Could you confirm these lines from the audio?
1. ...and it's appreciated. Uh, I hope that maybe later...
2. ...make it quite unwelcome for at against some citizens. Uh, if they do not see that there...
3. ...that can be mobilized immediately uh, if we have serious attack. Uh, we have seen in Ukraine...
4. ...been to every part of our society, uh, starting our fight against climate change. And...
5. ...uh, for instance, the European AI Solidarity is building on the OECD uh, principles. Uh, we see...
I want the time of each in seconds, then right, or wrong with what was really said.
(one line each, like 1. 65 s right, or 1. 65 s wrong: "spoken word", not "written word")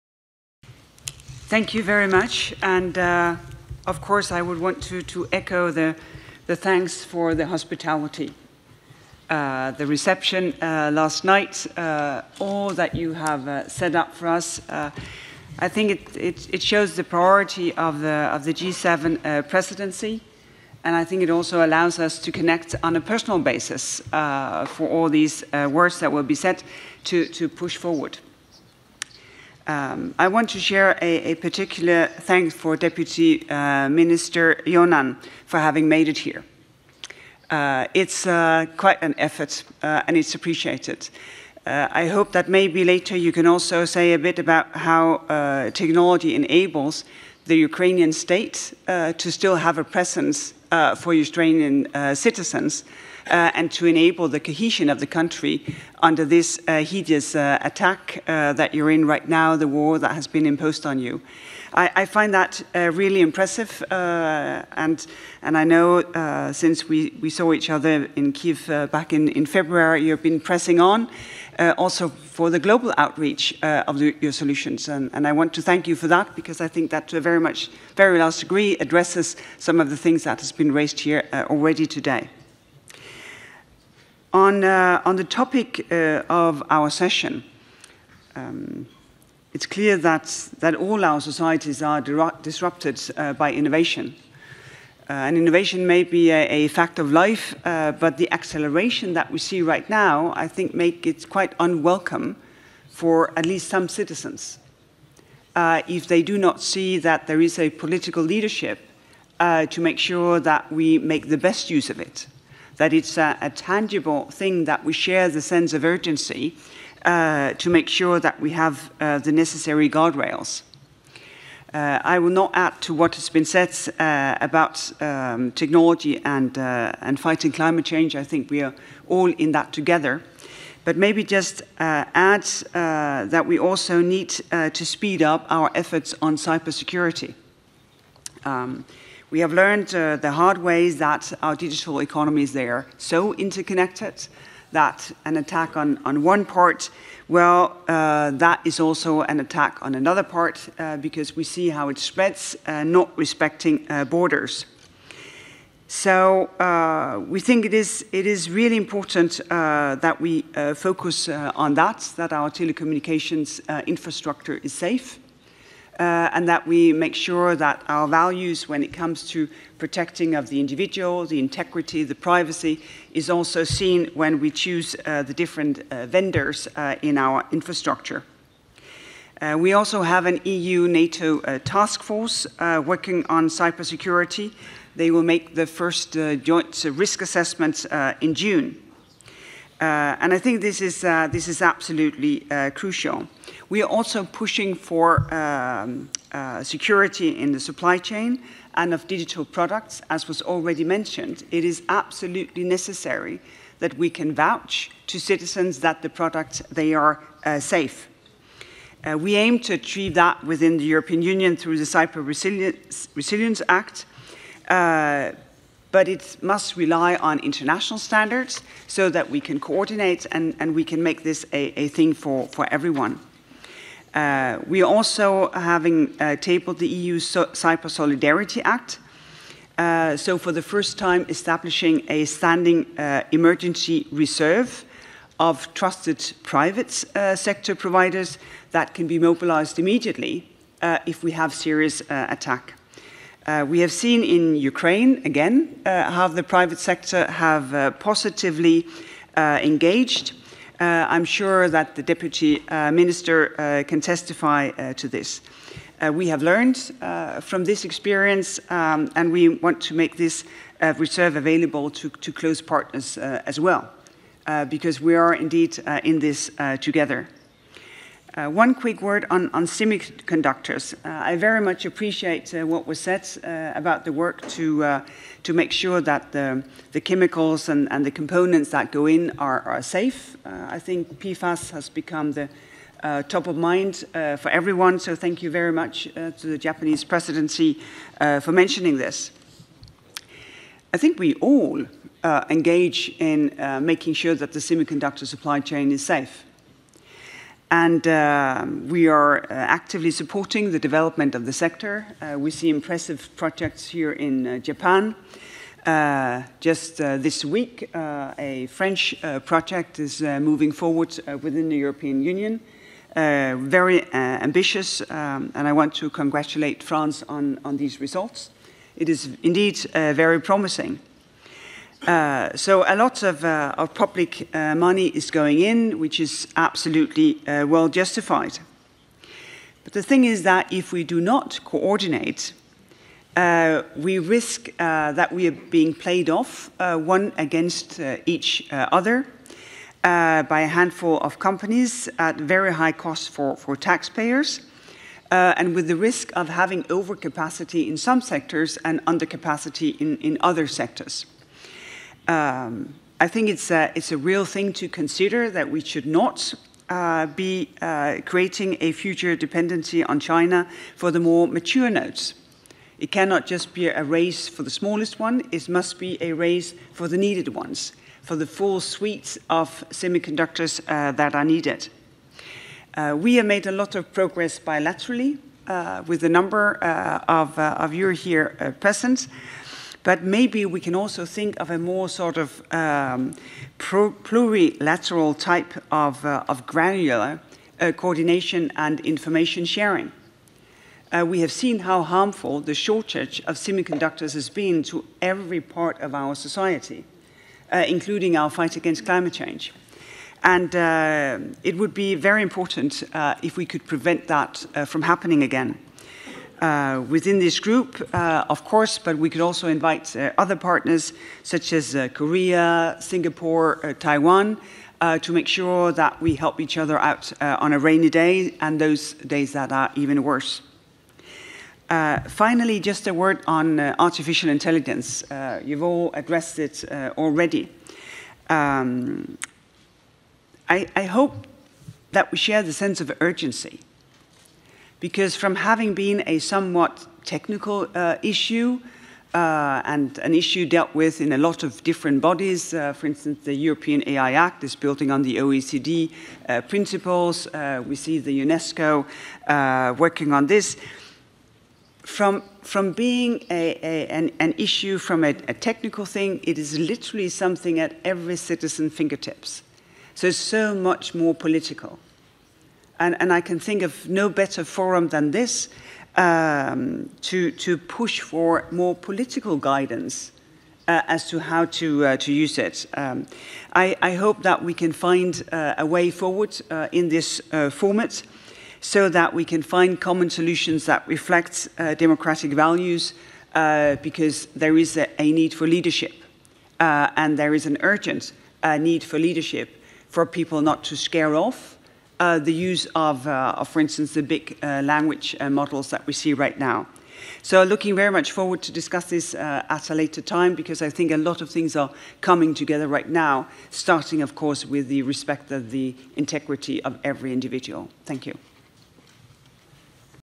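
1. 40 s right
2. 100 s wrong: "least", not "against"
3. 238 s right
4. 394 s wrong: "including", not "starting"
5. 442 s wrong: "Act", not "Solidarity".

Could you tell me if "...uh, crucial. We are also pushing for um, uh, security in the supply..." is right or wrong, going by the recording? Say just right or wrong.
right.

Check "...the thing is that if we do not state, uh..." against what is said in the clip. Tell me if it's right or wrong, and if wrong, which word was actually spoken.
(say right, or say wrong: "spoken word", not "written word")
wrong: "coordinate", not "state".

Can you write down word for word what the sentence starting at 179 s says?
Uh, we also have an EU-NATO uh, task force working on cybersecurity.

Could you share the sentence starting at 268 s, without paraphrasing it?
Uh, one quick word on, on semiconductors.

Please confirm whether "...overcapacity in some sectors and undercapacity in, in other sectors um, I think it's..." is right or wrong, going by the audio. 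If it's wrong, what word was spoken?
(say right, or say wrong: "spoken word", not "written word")
right.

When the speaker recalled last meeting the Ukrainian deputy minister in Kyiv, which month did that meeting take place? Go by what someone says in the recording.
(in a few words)
February.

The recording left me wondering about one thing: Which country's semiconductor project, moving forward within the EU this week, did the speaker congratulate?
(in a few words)
France.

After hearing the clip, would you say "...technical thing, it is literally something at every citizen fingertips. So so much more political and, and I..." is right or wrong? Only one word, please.
right.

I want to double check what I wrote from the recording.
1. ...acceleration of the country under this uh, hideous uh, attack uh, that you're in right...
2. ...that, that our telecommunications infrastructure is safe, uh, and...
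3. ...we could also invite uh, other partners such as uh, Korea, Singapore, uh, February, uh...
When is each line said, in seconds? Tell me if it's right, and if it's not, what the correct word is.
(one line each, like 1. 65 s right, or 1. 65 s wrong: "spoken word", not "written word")
1. 54 s wrong: "cohesion", not "acceleration"
2. 161 s right
3. 409 s wrong: "Taiwan", not "February".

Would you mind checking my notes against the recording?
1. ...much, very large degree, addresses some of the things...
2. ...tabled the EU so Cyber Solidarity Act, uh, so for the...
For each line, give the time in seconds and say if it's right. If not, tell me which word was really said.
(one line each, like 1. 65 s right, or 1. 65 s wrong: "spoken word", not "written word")
1. 77 s right
2. 226 s right.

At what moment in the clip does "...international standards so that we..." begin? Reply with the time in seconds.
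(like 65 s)
217 s.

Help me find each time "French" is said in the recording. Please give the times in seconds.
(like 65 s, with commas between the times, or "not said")
308 s.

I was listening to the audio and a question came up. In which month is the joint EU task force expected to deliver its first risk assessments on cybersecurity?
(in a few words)
June.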